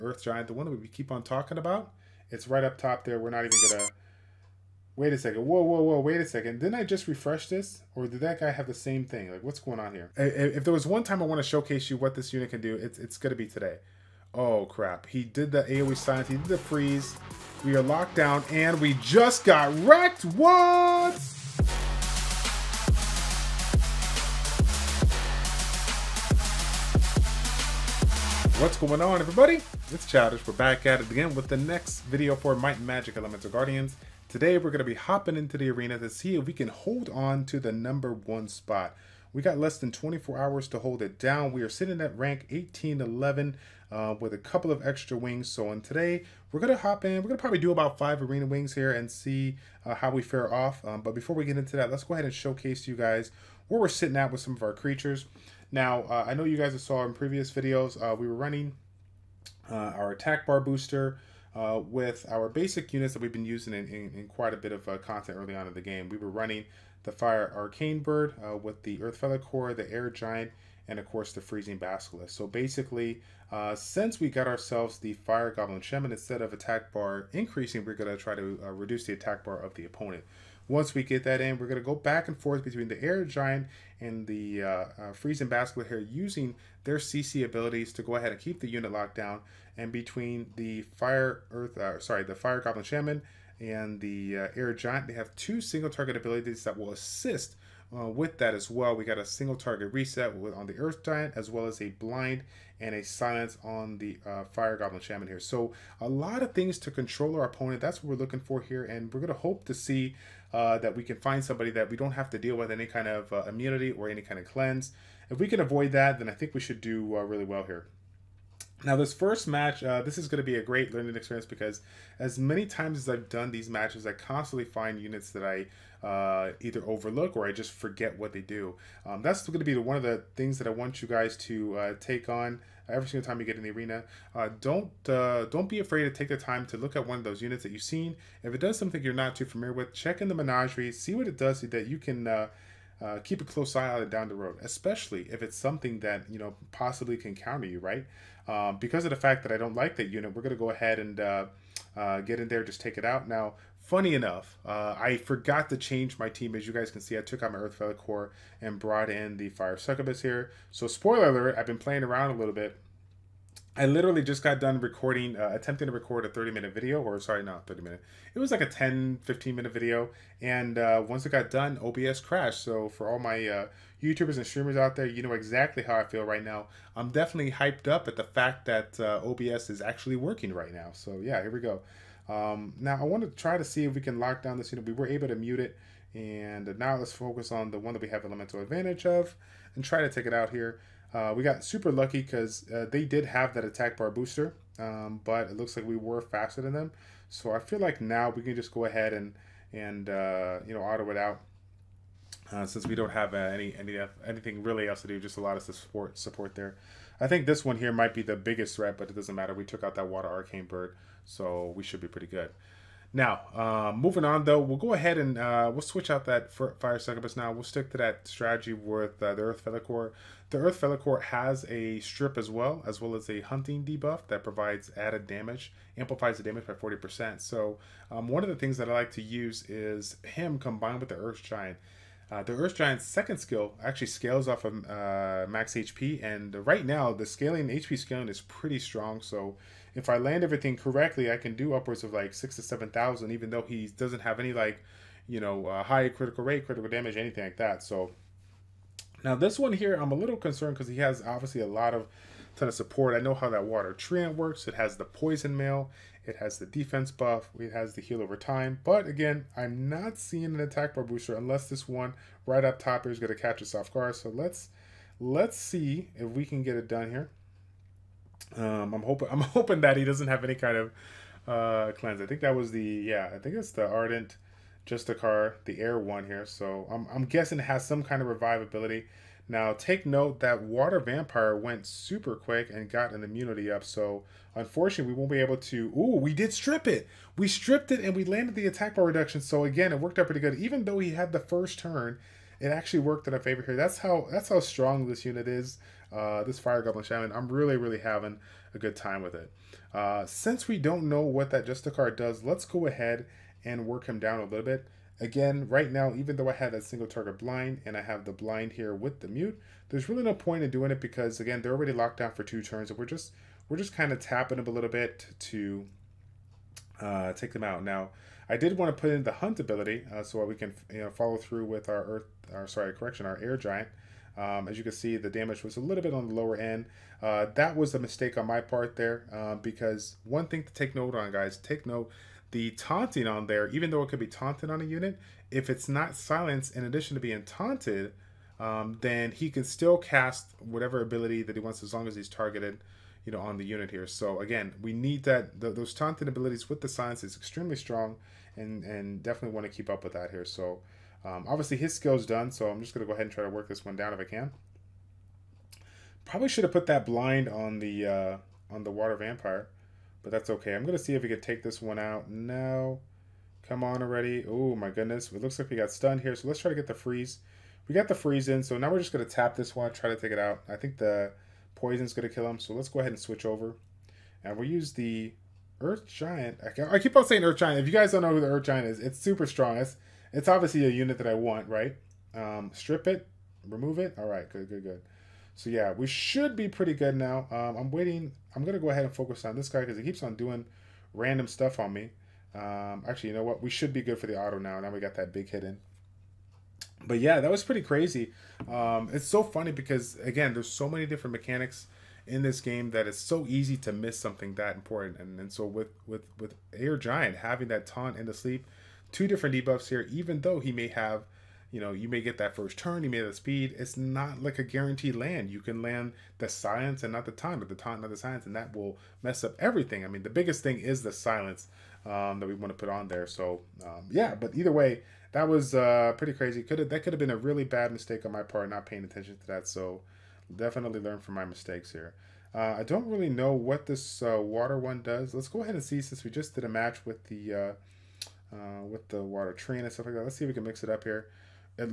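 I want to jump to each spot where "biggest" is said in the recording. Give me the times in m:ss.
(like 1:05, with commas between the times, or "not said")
3:28, 7:00.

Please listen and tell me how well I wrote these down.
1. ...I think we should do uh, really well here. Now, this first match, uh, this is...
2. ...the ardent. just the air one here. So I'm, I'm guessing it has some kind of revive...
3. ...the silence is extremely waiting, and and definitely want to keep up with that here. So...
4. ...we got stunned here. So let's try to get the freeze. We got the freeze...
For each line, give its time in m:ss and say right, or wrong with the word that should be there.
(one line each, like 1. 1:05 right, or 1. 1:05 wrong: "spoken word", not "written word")
1. 1:56 right
2. 4:33 right
3. 5:46 wrong: "strong", not "waiting"
4. 6:05 right.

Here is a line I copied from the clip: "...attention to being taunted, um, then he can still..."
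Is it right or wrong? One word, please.
wrong.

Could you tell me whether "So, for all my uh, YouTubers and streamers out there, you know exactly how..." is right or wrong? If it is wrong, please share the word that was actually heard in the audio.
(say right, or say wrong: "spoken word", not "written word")
right.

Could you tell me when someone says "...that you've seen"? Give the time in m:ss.
2:17.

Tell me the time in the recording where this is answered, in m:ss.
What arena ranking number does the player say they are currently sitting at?
0:42.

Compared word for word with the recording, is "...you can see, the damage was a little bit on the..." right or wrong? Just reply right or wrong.
right.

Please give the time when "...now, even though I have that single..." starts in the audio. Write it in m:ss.
5:05.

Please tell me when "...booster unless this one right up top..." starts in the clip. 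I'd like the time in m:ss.
4:21.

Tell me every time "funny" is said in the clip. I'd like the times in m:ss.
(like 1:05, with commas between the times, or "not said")
2:33, 6:39.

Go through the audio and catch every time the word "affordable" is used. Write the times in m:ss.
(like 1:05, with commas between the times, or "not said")
not said.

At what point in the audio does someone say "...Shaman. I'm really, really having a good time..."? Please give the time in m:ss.
4:57.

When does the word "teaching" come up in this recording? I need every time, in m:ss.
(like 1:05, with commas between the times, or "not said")
not said.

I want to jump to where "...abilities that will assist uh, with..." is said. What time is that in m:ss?
1:36.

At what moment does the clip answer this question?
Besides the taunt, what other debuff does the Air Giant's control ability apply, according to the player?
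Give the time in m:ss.
6:48.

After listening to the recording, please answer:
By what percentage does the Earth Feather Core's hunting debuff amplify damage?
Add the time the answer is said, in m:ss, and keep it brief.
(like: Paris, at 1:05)
40%, at 3:46.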